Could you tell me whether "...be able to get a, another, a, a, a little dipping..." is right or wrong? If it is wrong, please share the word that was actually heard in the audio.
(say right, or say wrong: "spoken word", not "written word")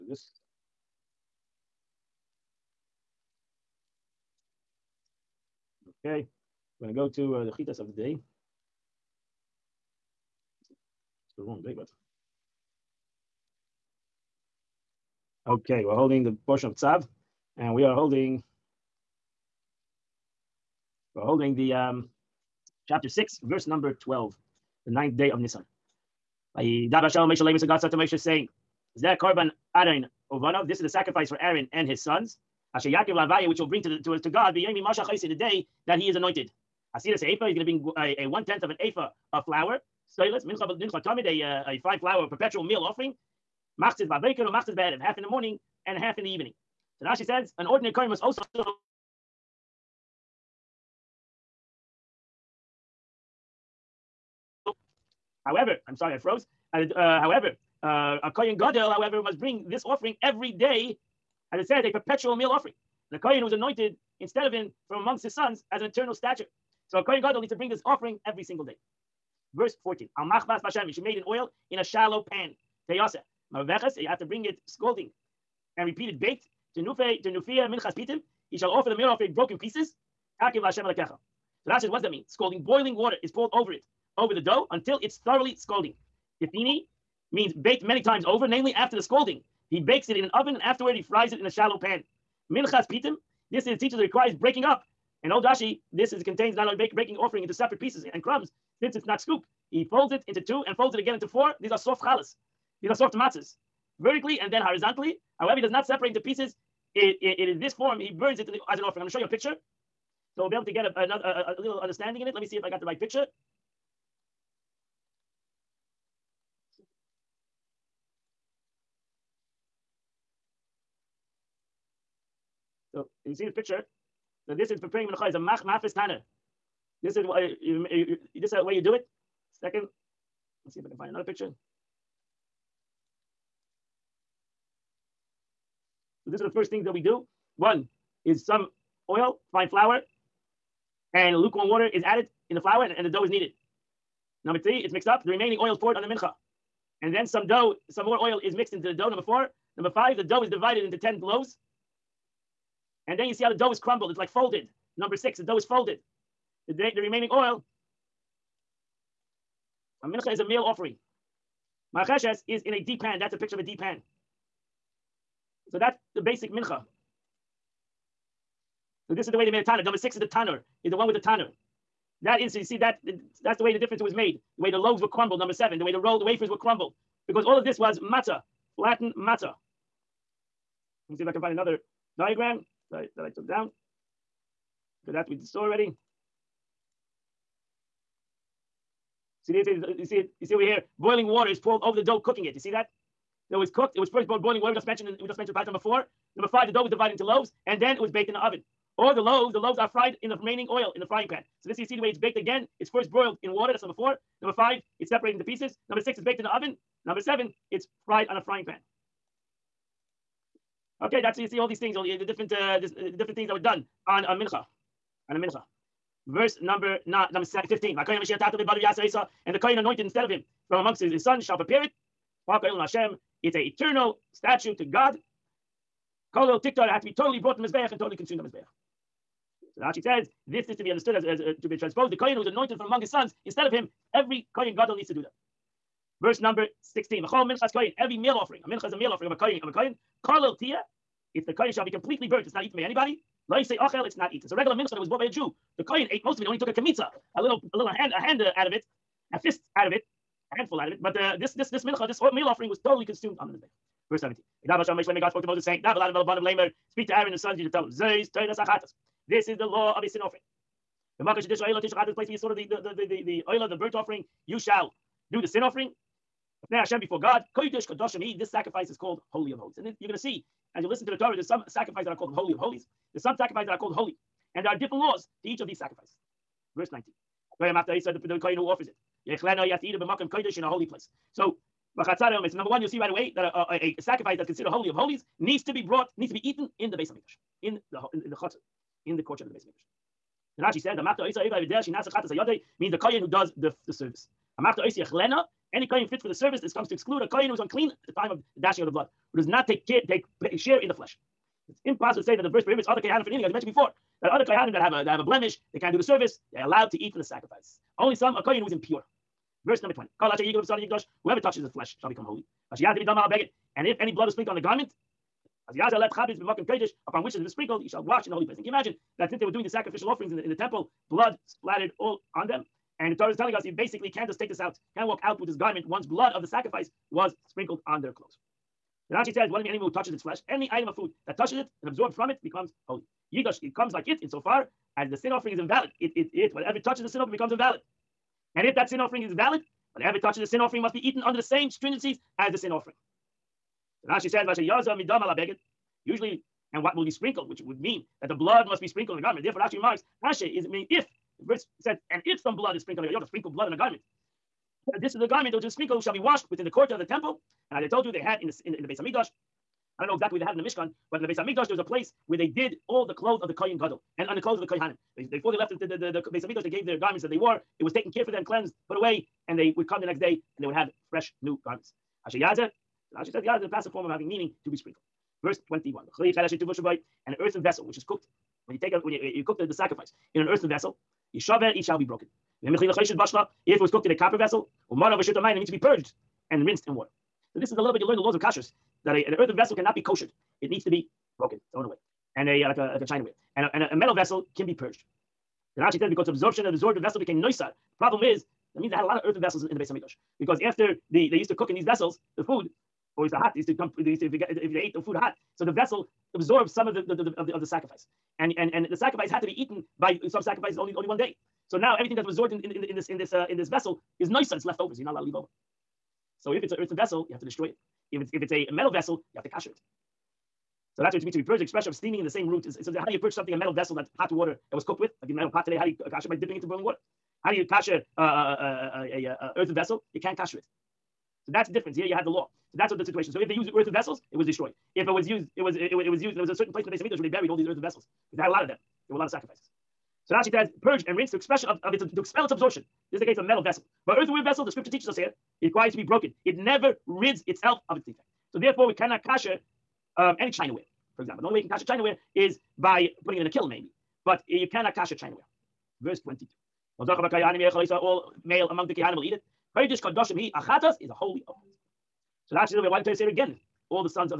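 wrong: "understanding", not "dipping".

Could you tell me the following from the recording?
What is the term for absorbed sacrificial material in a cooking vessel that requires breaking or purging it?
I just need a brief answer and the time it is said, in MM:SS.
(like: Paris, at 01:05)
Noisar, at 06:37.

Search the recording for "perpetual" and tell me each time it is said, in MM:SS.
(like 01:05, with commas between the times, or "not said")
00:42, 01:01.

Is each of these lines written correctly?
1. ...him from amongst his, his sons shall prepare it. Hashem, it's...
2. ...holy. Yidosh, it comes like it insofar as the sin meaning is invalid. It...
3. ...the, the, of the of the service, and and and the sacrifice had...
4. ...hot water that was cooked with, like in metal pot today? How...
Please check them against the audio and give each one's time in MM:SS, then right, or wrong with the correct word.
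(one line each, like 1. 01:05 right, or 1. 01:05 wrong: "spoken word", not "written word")
1. 03:40 right
2. 05:32 wrong: "offering", not "meaning"
3. 06:47 wrong: "sacrifice", not "service"
4. 07:04 right.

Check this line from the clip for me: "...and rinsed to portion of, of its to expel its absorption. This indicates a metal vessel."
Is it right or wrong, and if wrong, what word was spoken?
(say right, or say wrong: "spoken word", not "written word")
wrong: "expression", not "portion".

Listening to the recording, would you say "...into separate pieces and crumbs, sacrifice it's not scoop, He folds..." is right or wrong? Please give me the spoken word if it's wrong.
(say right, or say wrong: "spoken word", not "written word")
wrong: "since", not "sacrifice".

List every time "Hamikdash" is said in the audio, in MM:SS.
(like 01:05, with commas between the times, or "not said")
06:01, 06:06, 06:39.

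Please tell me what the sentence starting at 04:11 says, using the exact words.
But uh, this this this mincha, this meal offering, was totally consumed on the Mizbe'ach.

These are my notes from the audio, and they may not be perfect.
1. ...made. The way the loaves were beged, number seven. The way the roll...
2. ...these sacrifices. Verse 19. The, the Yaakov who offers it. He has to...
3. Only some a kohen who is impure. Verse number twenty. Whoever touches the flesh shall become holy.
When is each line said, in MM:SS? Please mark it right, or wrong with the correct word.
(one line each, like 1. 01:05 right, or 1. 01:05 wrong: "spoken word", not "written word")
1. 02:54 wrong: "crumbled", not "beged"
2. 04:35 wrong: "Kohen", not "Yaakov"
3. 05:07 right.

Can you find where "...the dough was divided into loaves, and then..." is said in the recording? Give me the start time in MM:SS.
03:16.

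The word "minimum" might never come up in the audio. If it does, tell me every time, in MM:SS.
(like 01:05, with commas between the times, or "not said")
not said.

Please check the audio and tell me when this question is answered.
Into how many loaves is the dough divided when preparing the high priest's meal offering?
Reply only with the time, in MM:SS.
02:30.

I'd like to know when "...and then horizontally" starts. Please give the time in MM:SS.
01:44.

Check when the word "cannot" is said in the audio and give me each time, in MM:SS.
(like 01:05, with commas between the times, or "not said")
06:29, 07:28, 07:34.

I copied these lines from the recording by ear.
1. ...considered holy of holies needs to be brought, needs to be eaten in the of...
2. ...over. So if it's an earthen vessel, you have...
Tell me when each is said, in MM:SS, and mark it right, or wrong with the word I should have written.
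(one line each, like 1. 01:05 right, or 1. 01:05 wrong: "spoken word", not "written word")
1. 04:44 right
2. 06:55 right.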